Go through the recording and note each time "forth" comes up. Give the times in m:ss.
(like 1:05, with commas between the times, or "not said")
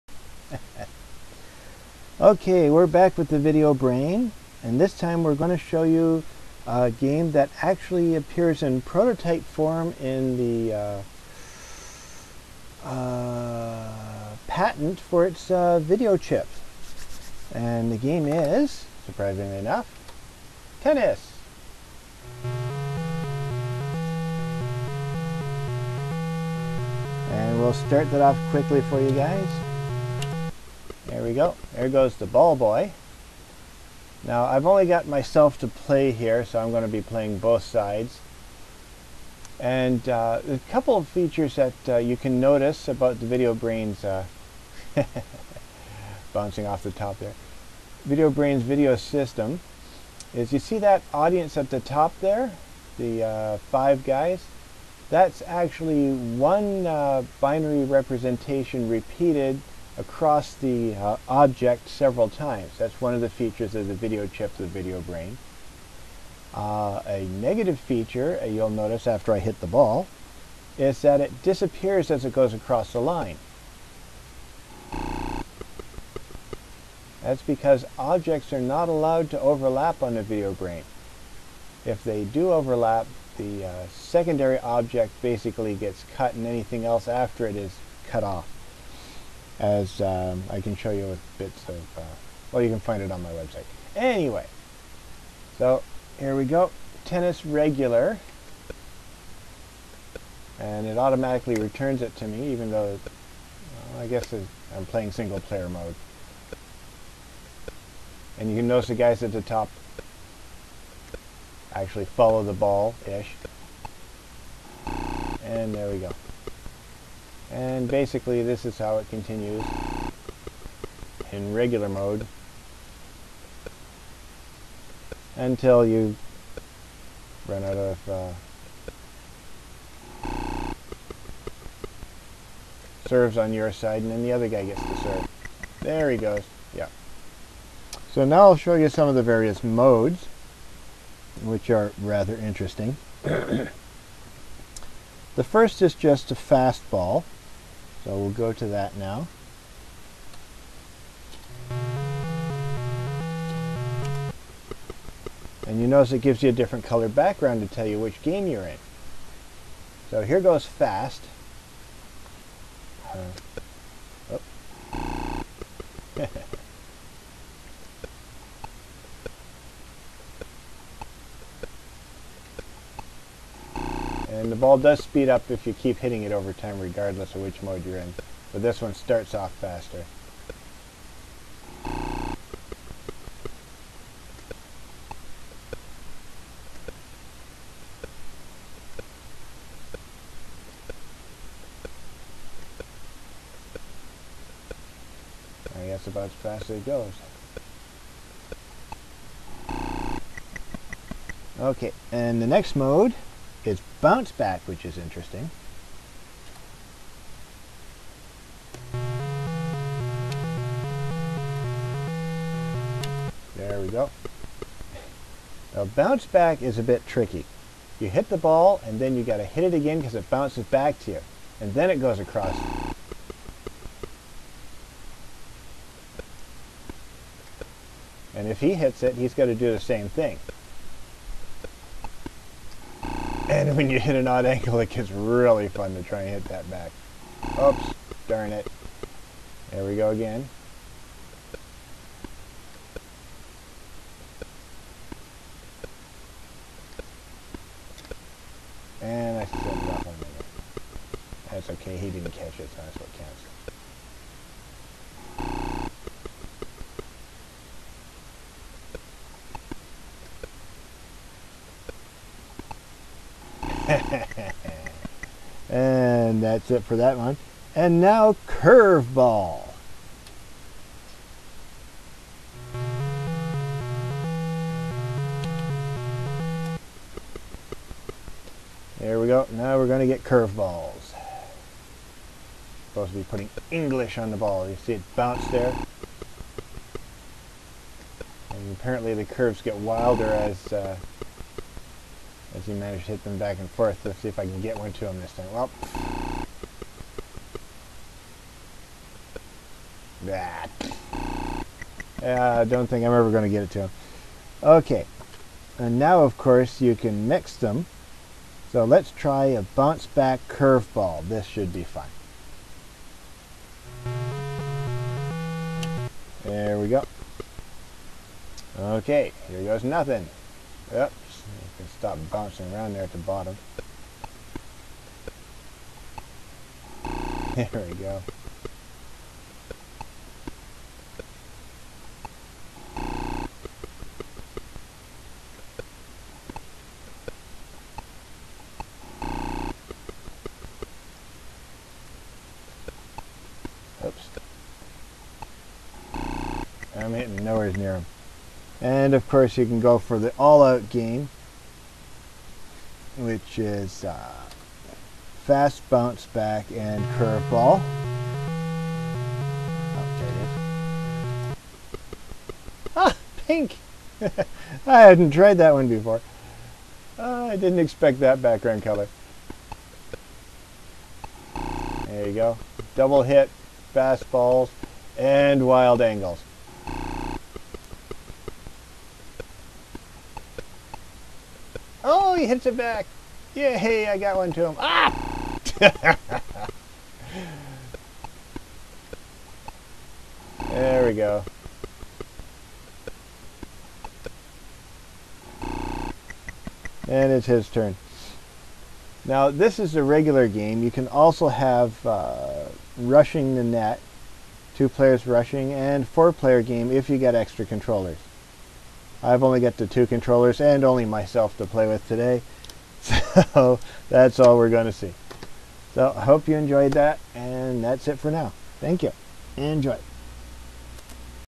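4:53.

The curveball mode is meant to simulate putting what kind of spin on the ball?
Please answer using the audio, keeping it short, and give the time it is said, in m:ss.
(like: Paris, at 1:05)
English, at 4:43.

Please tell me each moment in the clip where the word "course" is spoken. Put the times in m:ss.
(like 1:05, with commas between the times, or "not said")
5:06, 5:49.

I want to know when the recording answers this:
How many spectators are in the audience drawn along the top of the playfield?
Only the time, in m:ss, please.
0:53.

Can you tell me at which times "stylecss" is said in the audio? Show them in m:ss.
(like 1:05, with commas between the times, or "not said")
not said.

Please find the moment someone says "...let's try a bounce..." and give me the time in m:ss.
5:08.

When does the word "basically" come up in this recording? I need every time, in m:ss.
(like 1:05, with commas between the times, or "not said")
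1:25, 1:57.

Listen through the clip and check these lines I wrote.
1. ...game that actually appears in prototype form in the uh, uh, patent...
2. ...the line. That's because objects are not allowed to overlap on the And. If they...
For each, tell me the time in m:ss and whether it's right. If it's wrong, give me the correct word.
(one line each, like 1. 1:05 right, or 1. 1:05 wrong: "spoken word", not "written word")
1. 0:06 right
2. 1:12 wrong: "VideoBrain", not "And".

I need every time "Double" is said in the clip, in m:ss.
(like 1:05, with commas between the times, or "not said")
6:12.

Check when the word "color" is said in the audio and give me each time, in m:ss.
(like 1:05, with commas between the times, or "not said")
2:36, 6:08.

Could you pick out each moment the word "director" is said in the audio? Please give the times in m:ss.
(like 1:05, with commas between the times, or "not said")
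not said.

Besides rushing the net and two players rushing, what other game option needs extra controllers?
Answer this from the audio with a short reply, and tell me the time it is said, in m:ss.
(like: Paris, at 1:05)
Four-player game, at 6:46.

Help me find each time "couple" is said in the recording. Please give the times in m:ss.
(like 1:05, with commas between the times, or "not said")
0:40.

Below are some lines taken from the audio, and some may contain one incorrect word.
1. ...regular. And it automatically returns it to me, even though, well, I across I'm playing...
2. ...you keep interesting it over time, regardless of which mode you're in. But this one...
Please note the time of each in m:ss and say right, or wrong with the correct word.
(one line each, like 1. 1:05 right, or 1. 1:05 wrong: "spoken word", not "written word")
1. 1:37 wrong: "guess", not "across"
2. 2:55 wrong: "hitting", not "interesting".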